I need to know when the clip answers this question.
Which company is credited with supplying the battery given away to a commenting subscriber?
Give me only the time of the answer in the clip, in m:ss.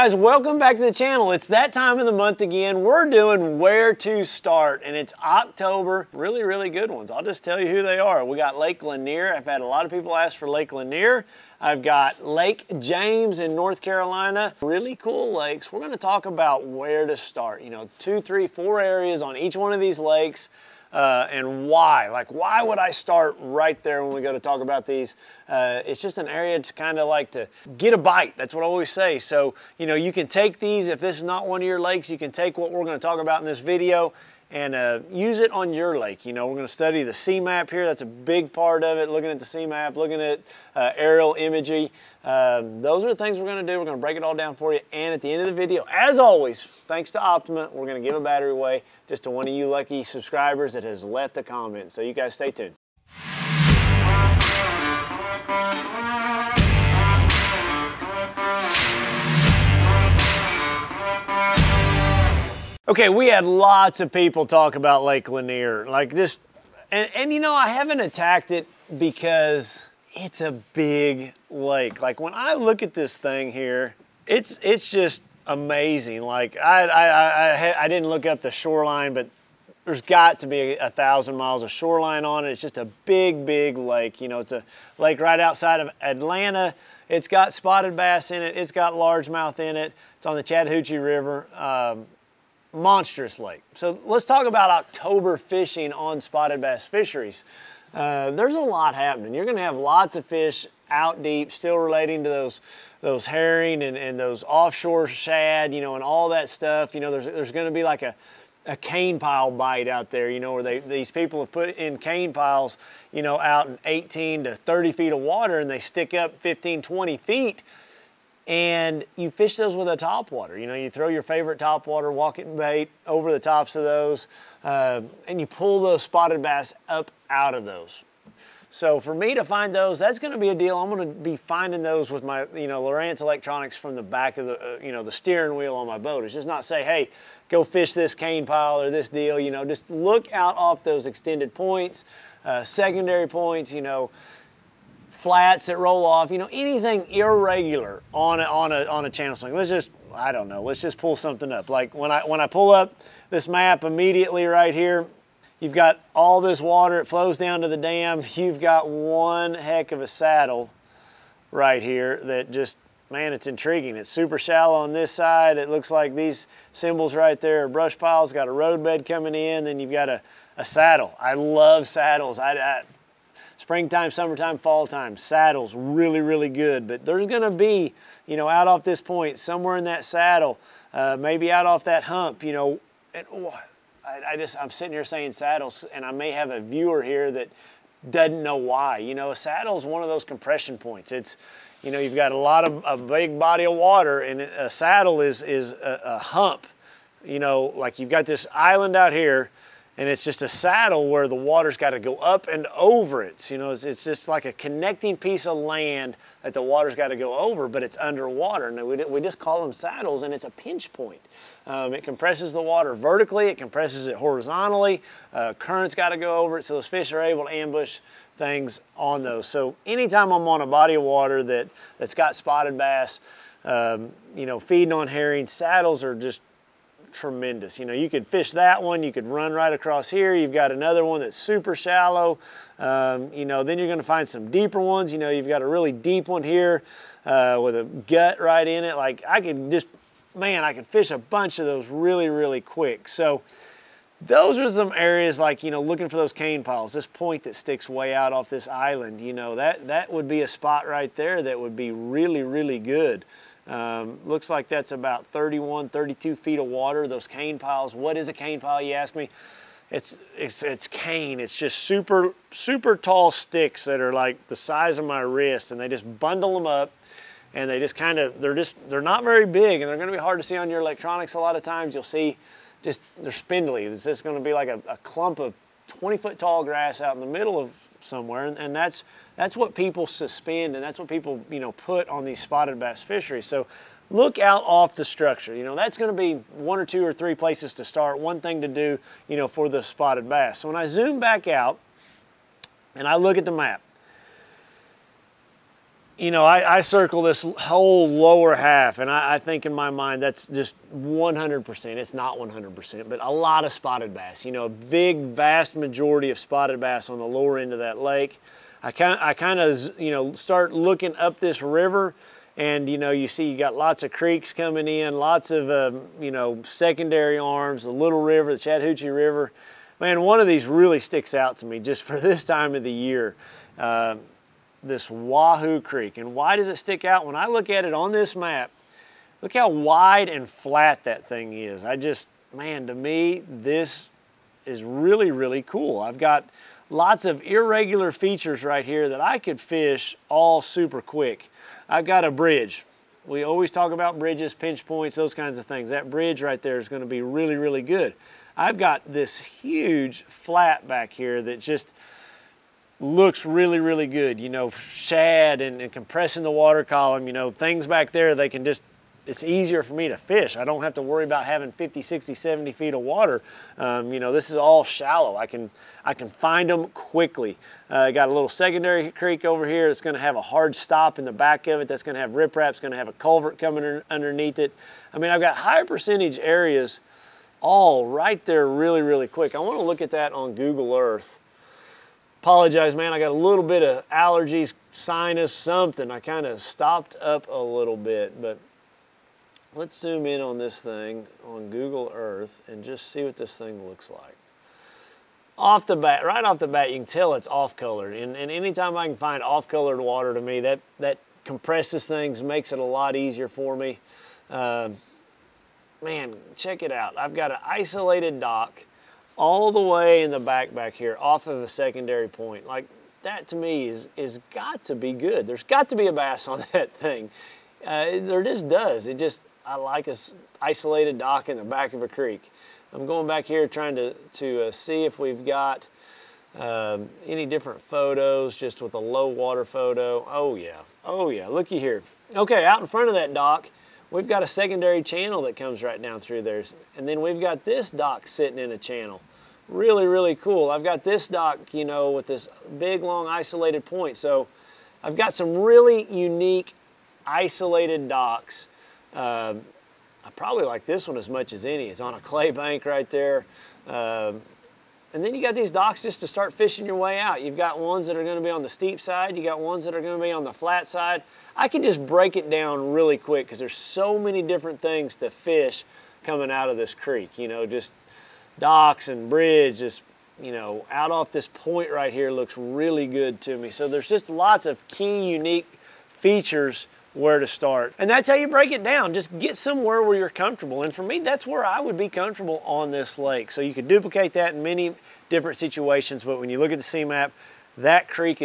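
0:47.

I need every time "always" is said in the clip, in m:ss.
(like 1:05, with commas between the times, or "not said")
0:28, 0:46, 5:43.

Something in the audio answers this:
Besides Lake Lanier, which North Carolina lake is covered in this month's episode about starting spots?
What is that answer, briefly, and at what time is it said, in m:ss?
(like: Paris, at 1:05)
Lake James, at 0:12.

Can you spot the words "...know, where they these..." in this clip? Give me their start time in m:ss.
1:50.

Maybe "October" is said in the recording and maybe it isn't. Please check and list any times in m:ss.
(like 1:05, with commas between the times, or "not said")
0:05, 1:34.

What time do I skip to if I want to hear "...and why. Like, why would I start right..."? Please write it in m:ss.
0:21.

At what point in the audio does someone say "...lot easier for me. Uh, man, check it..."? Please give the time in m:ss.
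6:42.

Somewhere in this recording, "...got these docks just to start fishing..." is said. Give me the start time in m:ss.
7:35.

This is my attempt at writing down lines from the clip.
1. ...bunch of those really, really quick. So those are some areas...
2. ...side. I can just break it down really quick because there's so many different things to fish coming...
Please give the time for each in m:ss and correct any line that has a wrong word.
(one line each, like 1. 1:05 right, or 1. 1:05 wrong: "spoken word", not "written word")
1. 4:01 right
2. 7:40 right.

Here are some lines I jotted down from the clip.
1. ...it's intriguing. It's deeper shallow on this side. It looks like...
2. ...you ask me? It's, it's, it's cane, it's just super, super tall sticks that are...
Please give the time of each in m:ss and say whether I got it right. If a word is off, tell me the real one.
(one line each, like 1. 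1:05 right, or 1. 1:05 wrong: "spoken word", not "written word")
1. 2:43 wrong: "super", not "deeper"
2. 4:18 right.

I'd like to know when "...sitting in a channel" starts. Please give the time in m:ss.
7:18.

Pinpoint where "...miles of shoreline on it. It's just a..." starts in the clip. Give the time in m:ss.
1:21.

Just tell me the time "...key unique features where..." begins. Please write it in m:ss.
7:54.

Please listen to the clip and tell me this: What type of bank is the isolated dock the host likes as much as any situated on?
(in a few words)
Clay bank.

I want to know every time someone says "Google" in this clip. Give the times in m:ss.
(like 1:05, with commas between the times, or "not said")
6:20, 6:31.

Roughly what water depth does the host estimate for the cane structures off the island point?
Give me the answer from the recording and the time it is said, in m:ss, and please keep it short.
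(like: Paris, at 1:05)
31 to 32 feet, at 4:15.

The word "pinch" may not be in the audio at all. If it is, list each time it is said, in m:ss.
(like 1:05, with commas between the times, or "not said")
3:30, 5:44.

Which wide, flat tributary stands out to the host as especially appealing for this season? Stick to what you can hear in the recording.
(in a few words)
Wahoo Creek.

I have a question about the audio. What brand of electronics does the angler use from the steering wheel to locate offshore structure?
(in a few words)
Lowrance.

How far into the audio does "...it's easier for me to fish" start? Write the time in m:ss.
5:59.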